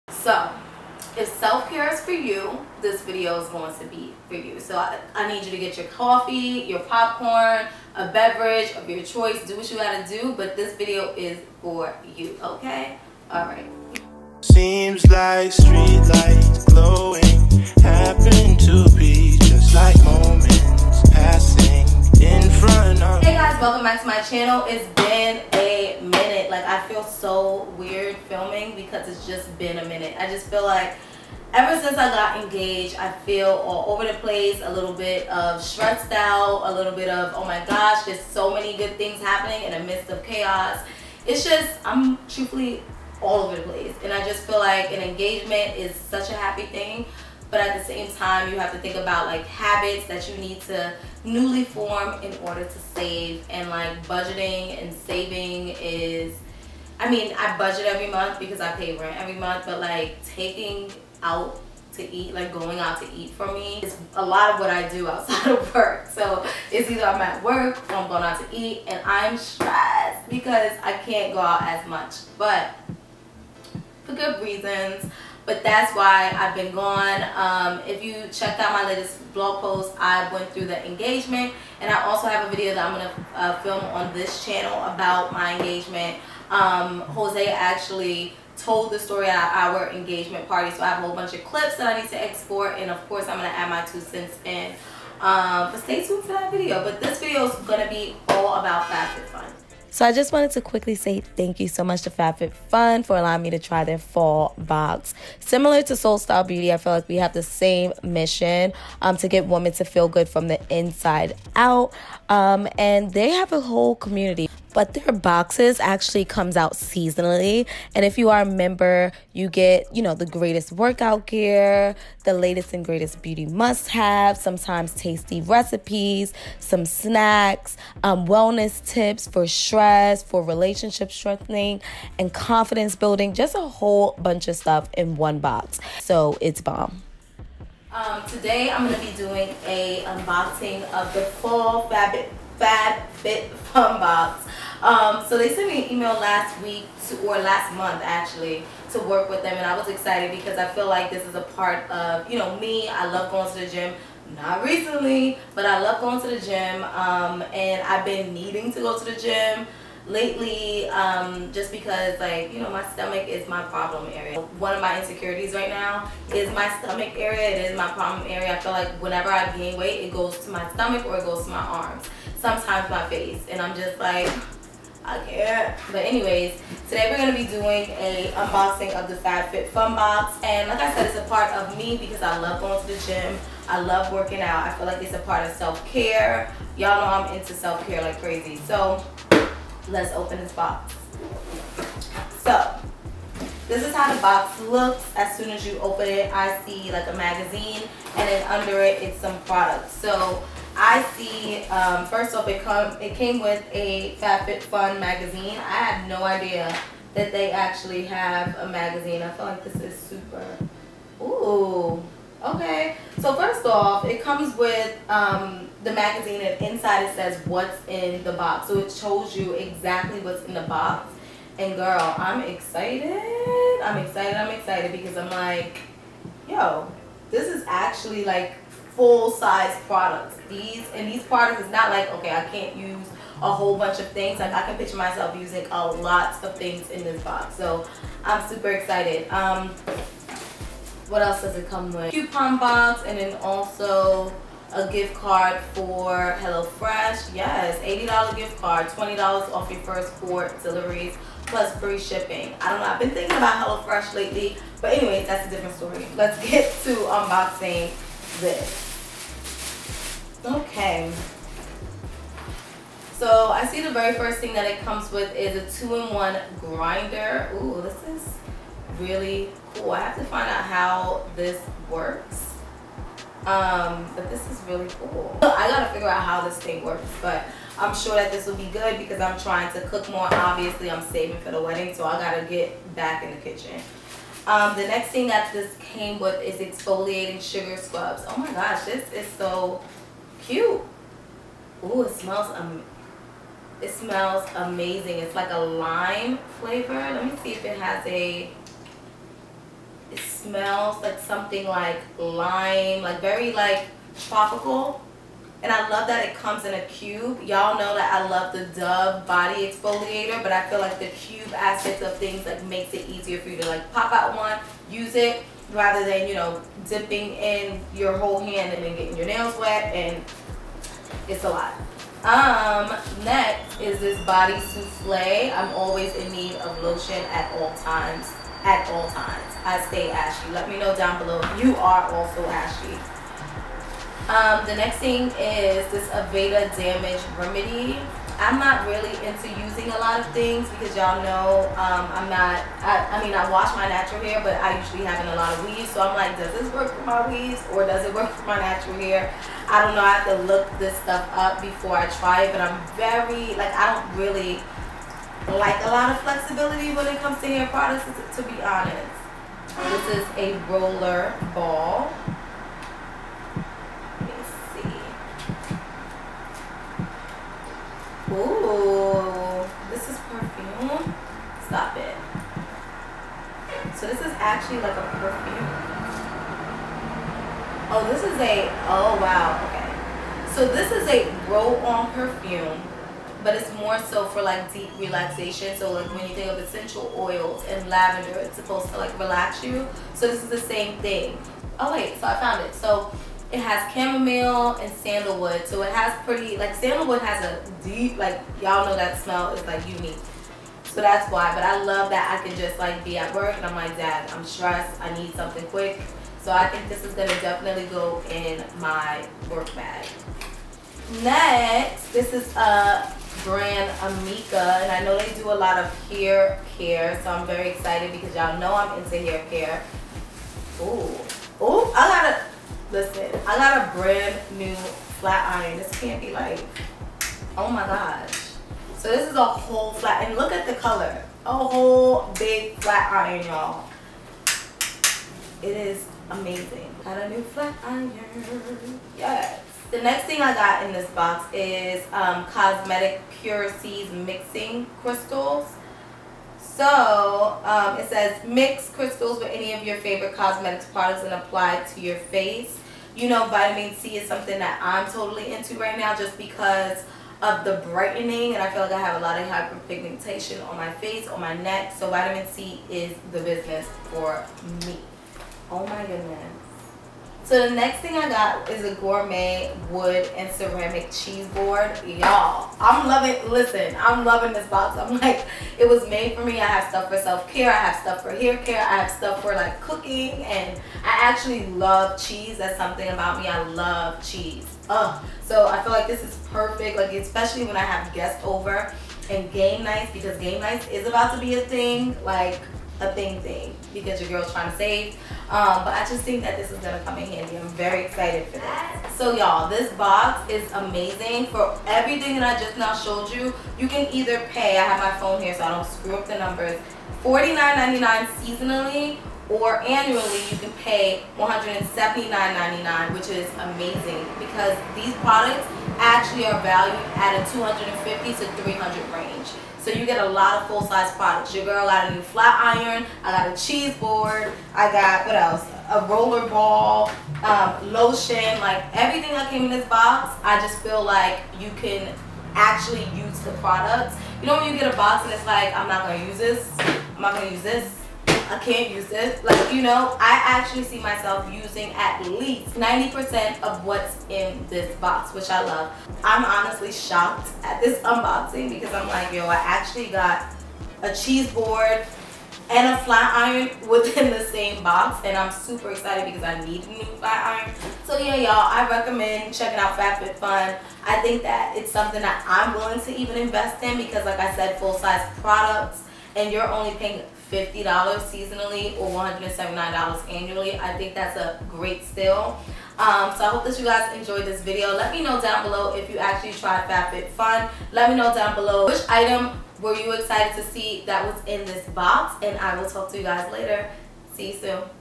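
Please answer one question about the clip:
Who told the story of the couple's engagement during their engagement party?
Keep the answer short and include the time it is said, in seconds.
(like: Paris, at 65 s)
Jose, at 87 s.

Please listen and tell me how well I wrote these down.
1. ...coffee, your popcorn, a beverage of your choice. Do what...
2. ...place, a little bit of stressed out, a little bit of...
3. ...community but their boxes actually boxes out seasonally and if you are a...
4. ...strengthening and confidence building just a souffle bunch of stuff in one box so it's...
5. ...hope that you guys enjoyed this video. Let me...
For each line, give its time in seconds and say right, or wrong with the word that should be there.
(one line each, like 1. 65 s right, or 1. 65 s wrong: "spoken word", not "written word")
1. 5 s right
2. 34 s right
3. 113 s wrong: "comes", not "boxes"
4. 131 s wrong: "whole", not "souffle"
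5. 573 s right.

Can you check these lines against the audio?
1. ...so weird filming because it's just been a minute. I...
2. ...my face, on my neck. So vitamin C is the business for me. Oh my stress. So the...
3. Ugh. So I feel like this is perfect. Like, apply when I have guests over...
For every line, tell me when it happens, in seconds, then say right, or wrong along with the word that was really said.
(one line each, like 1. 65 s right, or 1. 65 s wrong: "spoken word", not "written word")
1. 27 s right
2. 460 s wrong: "goodness", not "stress"
3. 484 s wrong: "especially", not "apply".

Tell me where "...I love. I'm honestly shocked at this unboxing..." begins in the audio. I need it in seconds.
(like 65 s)
545 s.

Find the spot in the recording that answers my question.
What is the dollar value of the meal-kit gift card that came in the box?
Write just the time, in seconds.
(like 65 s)
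247 s.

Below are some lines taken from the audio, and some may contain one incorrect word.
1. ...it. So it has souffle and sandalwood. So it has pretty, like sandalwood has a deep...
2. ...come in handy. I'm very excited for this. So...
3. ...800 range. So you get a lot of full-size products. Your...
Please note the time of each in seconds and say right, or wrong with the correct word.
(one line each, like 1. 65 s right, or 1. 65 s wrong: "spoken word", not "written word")
1. 392 s wrong: "chamomile", not "souffle"
2. 497 s right
3. 518 s wrong: "300", not "800".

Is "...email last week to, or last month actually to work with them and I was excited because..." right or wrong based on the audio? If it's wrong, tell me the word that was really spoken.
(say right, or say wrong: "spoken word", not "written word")
right.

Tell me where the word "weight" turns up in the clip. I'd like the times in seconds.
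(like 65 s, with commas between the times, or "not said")
169 s.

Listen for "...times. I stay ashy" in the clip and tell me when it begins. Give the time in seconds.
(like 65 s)
329 s.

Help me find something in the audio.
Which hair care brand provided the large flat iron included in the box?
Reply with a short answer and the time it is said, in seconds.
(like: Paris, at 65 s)
Amika, at 413 s.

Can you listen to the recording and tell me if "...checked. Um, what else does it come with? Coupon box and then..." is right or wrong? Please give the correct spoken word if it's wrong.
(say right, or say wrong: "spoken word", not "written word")
wrong: "excited", not "checked".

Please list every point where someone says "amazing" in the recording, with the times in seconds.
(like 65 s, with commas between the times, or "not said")
294 s, 436 s, 500 s, 513 s.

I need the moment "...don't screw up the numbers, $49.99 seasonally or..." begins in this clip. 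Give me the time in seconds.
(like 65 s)
505 s.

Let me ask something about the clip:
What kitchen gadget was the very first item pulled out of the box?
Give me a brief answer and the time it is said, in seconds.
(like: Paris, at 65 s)
two-in-one grinder, at 265 s.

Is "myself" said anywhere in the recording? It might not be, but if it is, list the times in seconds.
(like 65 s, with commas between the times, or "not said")
234 s, 540 s.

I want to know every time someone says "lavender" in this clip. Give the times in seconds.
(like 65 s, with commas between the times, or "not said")
387 s.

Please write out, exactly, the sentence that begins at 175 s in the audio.
But anyways, today we're gonna be doing a unboxing of the FabFitFun box.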